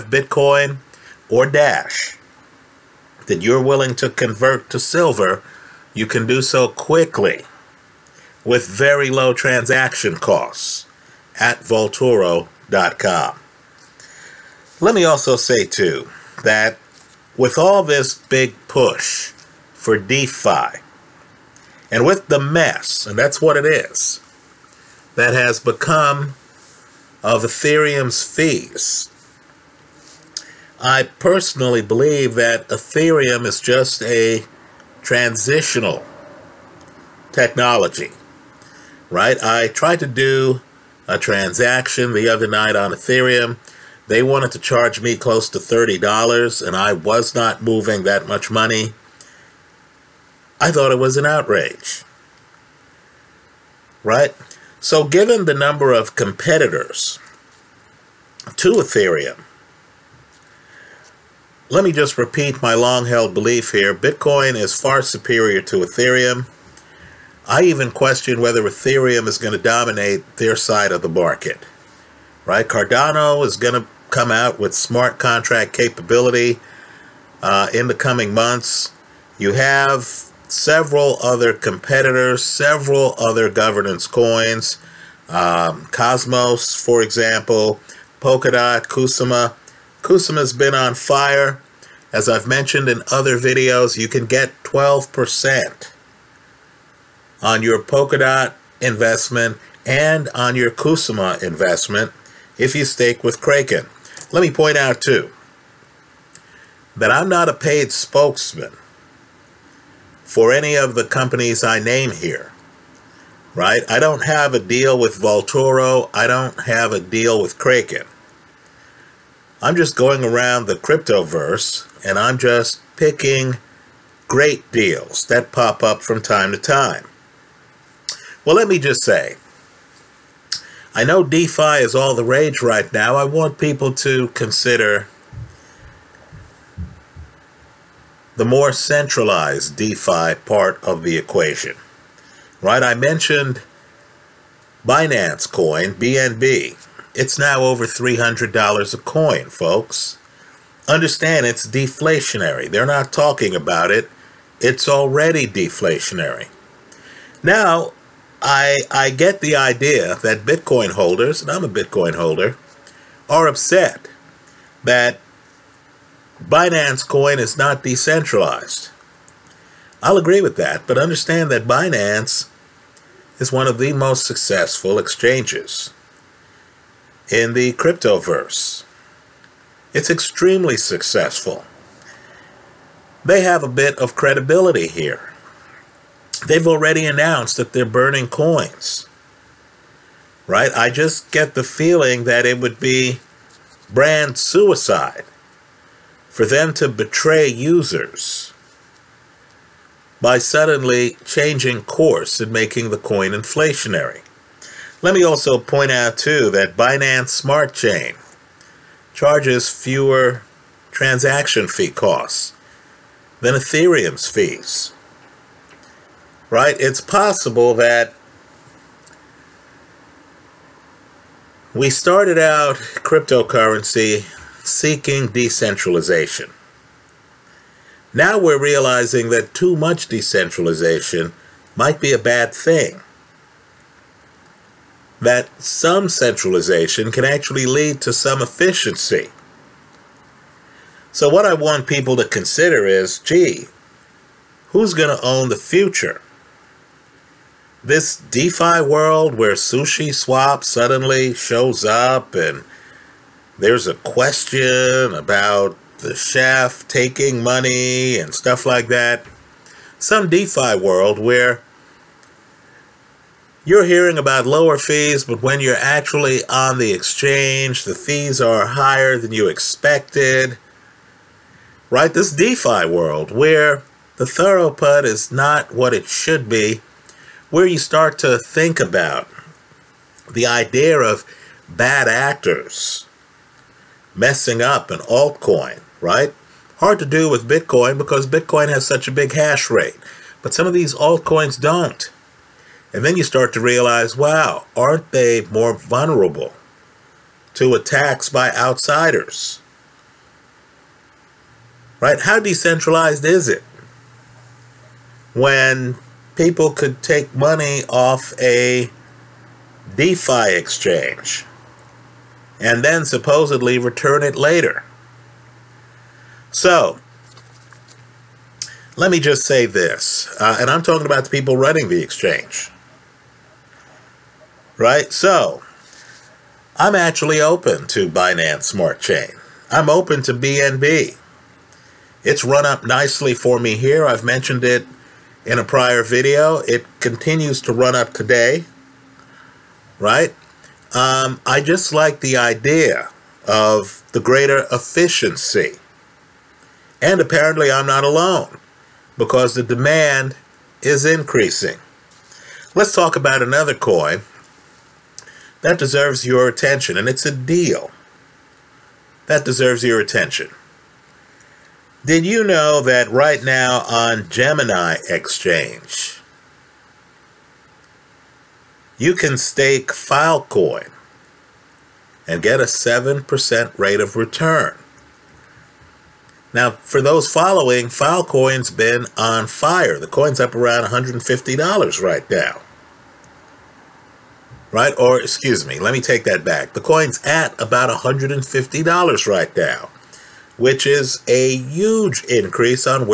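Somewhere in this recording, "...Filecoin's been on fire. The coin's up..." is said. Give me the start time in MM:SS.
06:17.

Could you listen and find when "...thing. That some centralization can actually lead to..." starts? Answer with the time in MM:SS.
03:52.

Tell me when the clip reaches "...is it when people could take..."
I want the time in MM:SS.
05:03.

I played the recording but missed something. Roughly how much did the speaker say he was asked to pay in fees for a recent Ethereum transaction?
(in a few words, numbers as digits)
$30.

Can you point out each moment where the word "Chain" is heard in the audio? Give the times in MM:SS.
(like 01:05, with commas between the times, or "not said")
03:27, 05:29.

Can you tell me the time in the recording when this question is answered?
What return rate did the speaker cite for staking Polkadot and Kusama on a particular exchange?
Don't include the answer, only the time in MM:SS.
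01:34.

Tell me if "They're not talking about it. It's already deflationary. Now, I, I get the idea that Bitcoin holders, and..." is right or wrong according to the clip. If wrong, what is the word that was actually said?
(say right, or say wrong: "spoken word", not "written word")
right.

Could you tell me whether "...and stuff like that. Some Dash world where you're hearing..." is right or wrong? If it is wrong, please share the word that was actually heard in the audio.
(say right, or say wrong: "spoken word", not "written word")
wrong: "DeFi", not "Dash".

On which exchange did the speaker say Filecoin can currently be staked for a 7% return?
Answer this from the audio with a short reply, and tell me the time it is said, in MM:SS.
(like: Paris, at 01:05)
Gemini, at 06:04.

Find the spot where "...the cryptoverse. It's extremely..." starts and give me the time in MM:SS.
02:57.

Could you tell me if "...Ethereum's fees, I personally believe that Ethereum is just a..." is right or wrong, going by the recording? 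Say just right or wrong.
right.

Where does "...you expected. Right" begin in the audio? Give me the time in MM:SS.
04:29.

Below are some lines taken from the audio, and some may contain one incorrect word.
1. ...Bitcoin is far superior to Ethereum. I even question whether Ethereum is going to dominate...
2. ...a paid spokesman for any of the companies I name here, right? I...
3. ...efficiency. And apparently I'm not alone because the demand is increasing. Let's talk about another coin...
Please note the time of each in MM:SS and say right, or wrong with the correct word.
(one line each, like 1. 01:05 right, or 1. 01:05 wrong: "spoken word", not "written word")
1. 01:03 right
2. 01:47 right
3. 05:44 right.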